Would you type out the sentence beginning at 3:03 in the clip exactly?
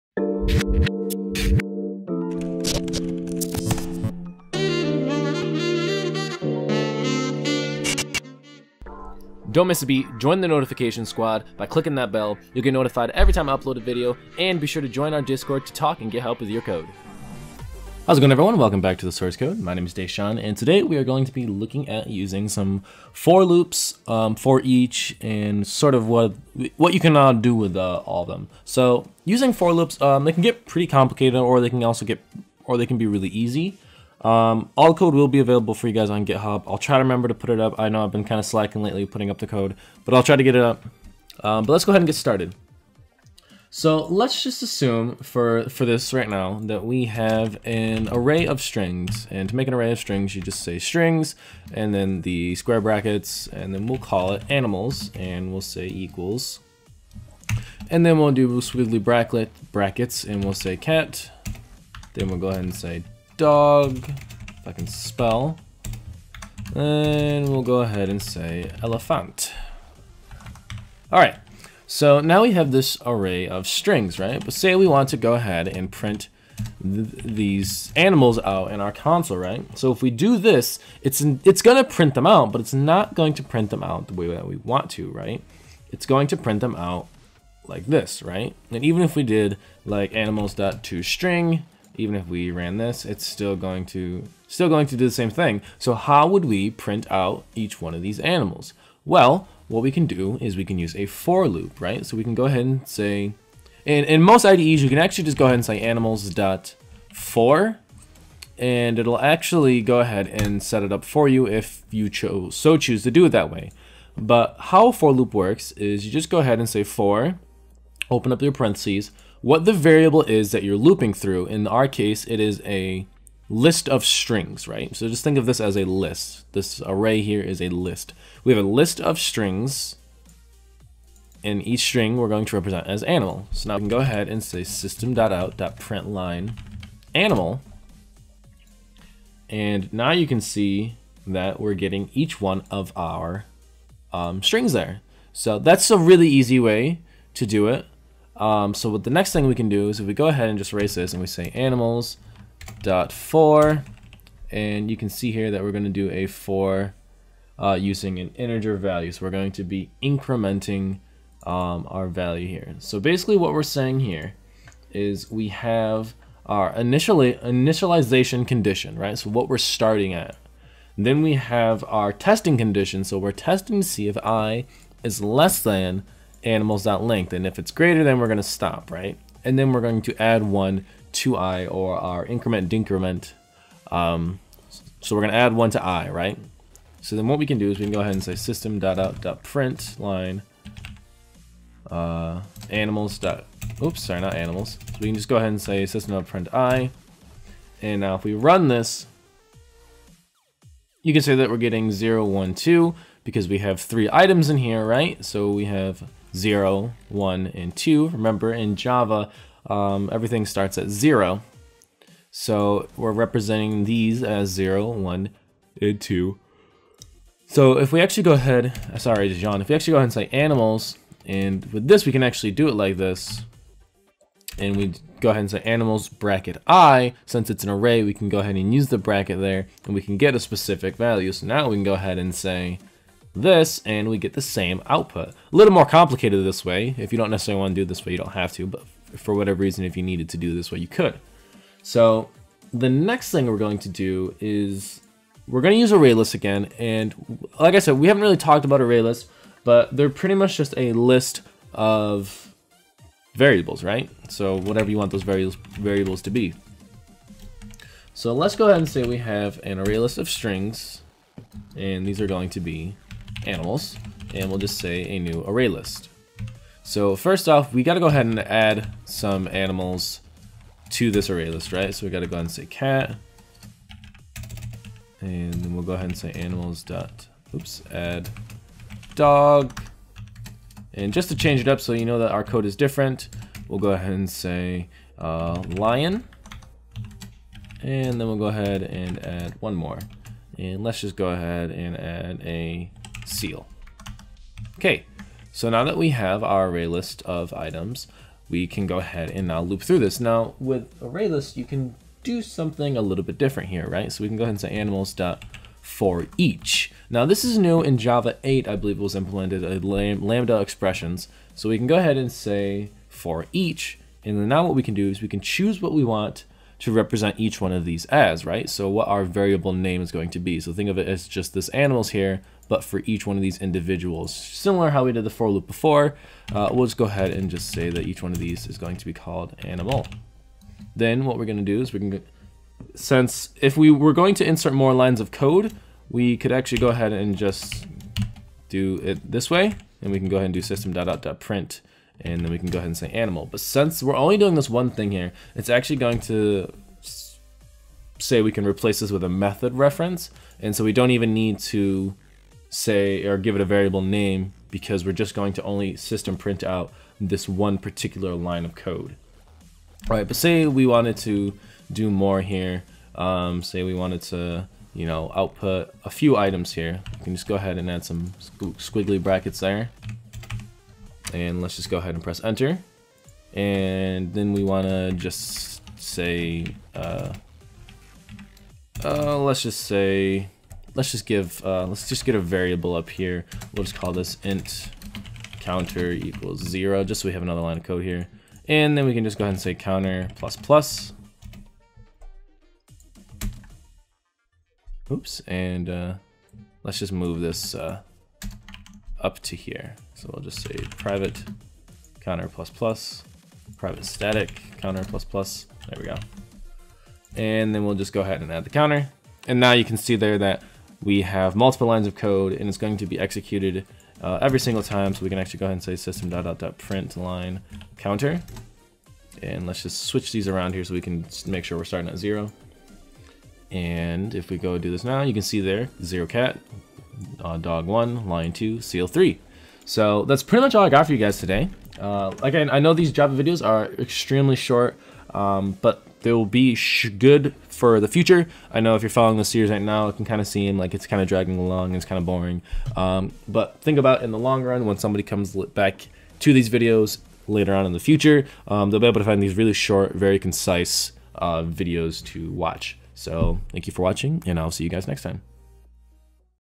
Um, so we're going to add one to i, right?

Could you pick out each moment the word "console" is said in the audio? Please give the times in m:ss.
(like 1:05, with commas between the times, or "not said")
1:18.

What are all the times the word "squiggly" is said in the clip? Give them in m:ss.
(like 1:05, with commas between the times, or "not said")
0:58, 6:08.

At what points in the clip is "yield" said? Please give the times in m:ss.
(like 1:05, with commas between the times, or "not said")
not said.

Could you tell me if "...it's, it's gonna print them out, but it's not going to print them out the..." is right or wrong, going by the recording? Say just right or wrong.
right.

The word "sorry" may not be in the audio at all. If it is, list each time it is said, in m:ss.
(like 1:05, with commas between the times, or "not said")
3:14, 3:39.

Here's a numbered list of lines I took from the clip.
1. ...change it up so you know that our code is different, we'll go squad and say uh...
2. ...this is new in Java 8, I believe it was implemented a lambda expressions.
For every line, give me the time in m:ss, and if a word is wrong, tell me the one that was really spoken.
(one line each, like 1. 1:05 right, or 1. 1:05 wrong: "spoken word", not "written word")
1. 4:41 wrong: "ahead", not "squad"
2. 5:07 right.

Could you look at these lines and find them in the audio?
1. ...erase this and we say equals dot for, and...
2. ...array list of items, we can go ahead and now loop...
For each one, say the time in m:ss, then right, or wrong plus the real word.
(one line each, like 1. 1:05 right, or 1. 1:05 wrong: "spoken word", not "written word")
1. 2:30 wrong: "animals", not "equals"
2. 4:56 right.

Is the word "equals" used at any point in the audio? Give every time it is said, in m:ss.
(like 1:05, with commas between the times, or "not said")
0:55, 6:26.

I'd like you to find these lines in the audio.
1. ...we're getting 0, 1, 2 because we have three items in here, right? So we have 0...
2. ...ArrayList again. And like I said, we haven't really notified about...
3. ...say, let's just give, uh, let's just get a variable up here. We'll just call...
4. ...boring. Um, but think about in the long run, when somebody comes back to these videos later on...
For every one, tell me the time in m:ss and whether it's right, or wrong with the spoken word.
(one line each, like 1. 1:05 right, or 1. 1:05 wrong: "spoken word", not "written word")
1. 3:21 right
2. 4:05 wrong: "talked", not "notified"
3. 6:19 right
4. 7:22 right.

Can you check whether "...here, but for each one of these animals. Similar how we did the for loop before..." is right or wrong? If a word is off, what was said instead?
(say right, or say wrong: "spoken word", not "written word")
wrong: "individuals", not "animals".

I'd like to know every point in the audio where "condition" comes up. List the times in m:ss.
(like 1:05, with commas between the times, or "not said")
2:48, 2:52.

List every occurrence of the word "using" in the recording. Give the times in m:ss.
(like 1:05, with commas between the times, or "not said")
0:22, 0:29, 2:37.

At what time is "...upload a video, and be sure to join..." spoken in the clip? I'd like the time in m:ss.
0:13.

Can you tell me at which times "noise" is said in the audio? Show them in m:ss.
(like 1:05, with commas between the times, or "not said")
not said.